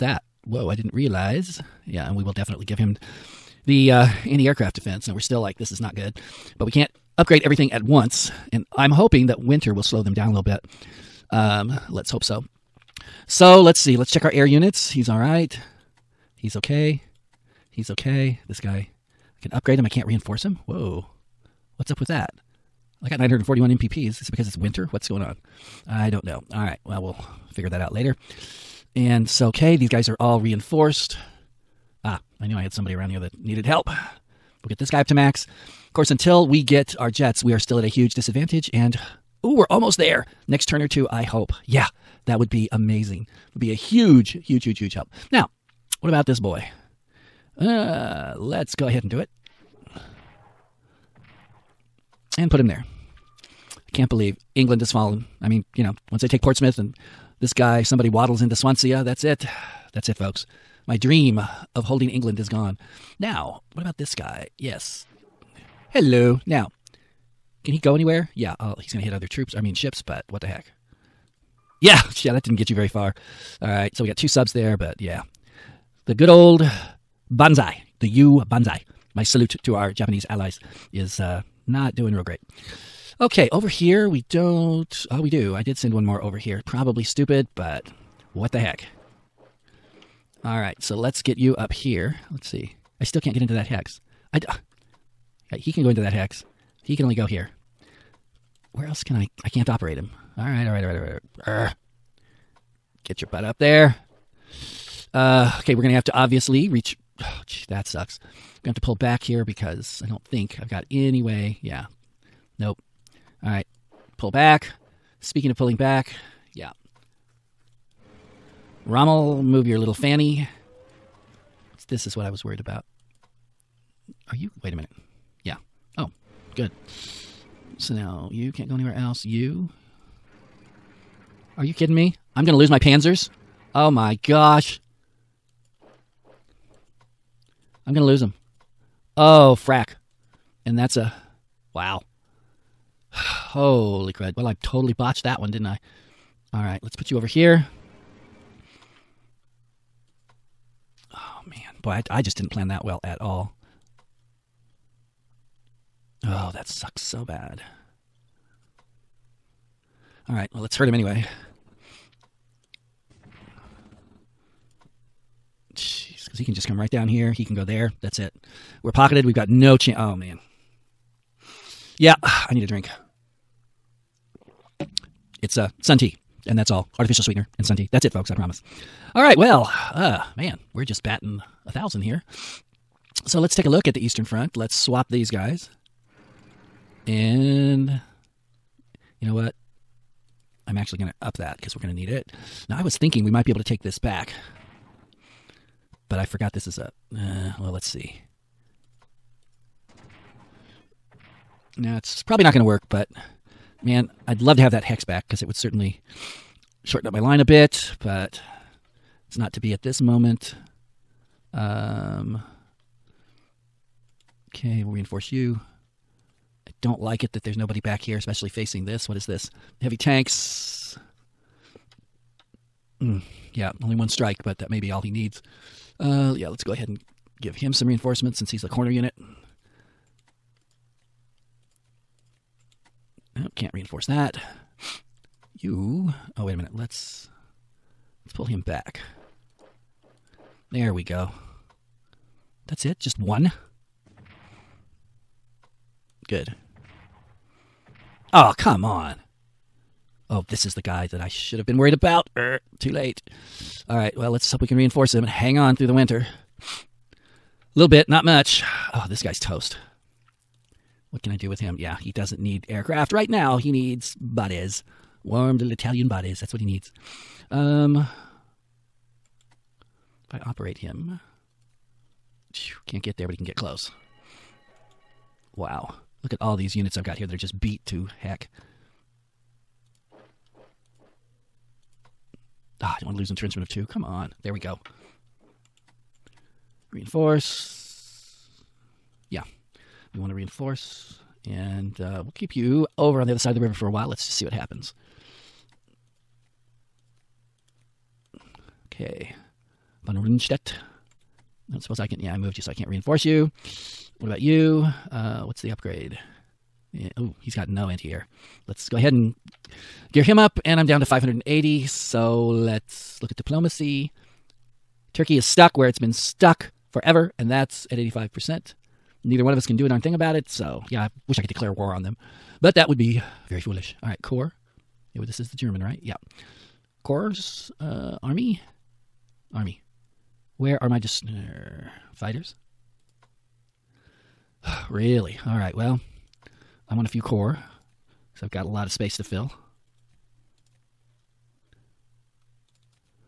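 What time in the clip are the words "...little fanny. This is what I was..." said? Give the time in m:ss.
1:59.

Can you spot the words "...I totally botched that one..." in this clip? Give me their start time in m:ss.
2:24.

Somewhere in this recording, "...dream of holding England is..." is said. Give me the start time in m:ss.
1:00.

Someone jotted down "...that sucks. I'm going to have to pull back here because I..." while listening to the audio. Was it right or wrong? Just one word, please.
right.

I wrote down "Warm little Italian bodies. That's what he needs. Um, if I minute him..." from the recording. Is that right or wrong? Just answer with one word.
wrong.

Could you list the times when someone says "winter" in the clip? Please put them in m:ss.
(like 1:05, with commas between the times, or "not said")
0:09, 0:24, 4:15.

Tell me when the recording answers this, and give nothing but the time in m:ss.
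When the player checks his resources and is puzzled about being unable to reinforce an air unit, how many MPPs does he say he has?
0:23.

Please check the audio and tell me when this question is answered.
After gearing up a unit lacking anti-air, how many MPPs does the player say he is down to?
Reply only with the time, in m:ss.
5:11.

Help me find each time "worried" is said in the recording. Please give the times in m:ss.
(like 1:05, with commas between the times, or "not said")
2:02, 4:11.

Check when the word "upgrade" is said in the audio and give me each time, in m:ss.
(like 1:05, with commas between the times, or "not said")
0:07, 0:19, 5:05.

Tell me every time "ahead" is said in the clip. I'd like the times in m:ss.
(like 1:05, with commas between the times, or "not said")
0:48, 3:46, 5:08.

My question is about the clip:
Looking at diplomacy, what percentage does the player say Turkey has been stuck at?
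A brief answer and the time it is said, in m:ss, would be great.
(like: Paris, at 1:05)
85%, at 5:17.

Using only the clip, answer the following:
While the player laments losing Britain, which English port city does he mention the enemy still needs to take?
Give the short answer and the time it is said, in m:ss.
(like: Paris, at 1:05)
Portsmouth, at 0:56.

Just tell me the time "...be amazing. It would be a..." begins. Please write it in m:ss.
0:42.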